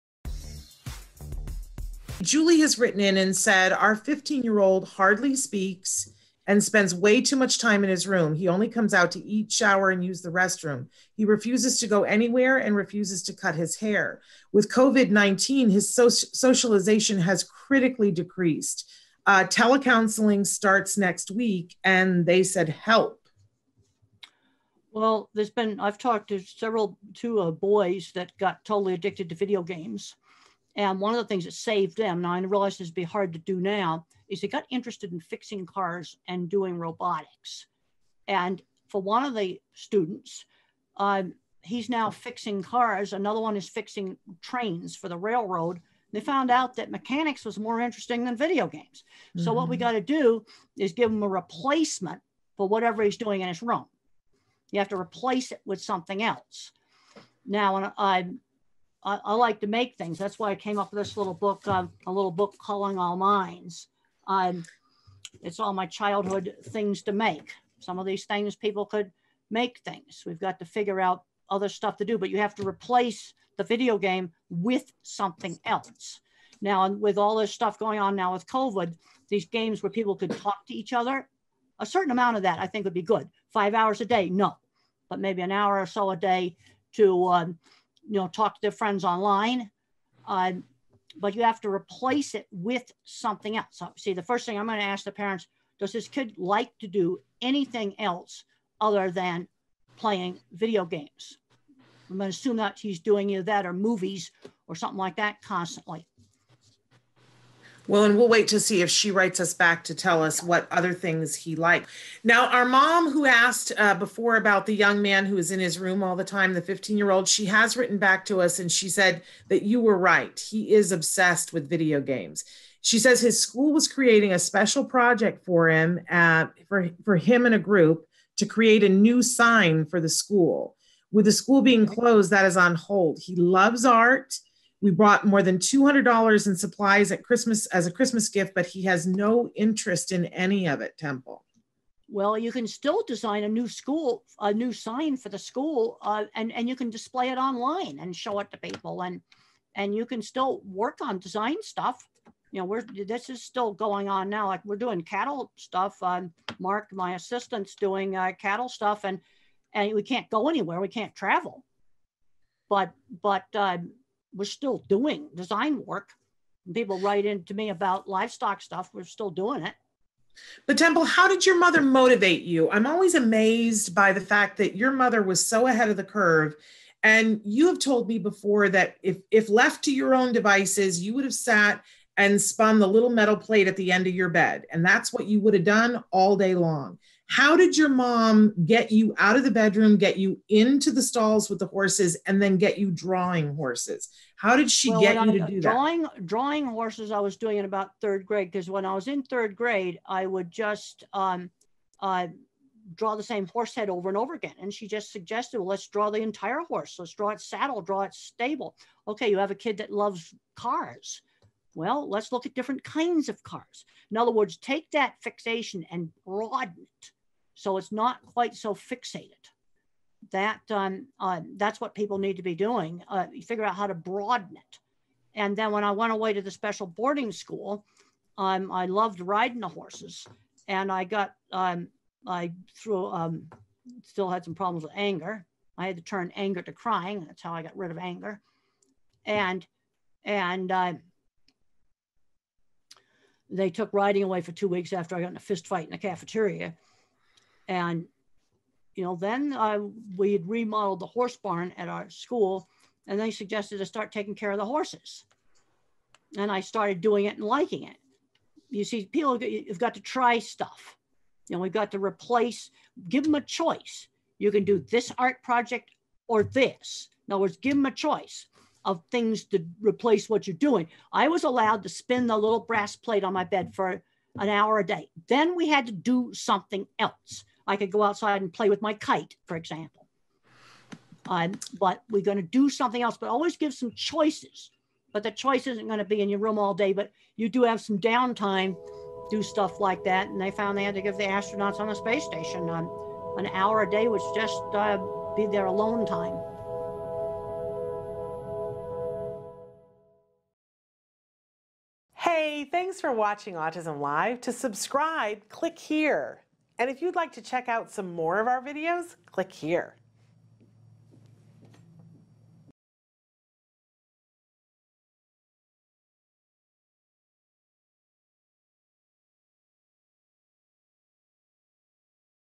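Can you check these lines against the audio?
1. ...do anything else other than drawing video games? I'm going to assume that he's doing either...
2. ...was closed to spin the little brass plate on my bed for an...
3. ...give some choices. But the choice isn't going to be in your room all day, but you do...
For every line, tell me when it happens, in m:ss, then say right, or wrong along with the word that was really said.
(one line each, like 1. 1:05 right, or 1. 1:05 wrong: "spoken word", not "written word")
1. 1:36 wrong: "playing", not "drawing"
2. 4:31 wrong: "allowed", not "closed"
3. 4:43 right.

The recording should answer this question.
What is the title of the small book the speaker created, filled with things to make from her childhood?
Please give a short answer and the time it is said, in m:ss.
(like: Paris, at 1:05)
Calling All Minds, at 1:02.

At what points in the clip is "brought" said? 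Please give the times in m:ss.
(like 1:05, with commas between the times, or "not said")
2:14.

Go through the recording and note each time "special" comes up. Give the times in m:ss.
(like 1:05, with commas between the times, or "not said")
2:04, 3:46.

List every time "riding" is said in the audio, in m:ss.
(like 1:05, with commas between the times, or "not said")
3:49, 4:03.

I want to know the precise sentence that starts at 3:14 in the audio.
How did she well, get you I, to do drawing, that?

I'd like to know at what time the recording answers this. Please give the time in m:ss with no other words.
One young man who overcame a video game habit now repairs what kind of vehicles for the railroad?
0:44.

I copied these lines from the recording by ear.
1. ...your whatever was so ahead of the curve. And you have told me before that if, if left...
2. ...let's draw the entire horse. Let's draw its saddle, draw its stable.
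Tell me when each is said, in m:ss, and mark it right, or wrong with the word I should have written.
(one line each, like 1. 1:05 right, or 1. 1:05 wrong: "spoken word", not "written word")
1. 2:54 wrong: "mother", not "whatever"
2. 3:25 right.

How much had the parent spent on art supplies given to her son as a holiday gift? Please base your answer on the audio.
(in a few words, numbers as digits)
$200.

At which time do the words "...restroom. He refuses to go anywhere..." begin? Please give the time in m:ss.
0:10.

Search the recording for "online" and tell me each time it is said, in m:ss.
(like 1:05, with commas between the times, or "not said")
1:29, 2:27.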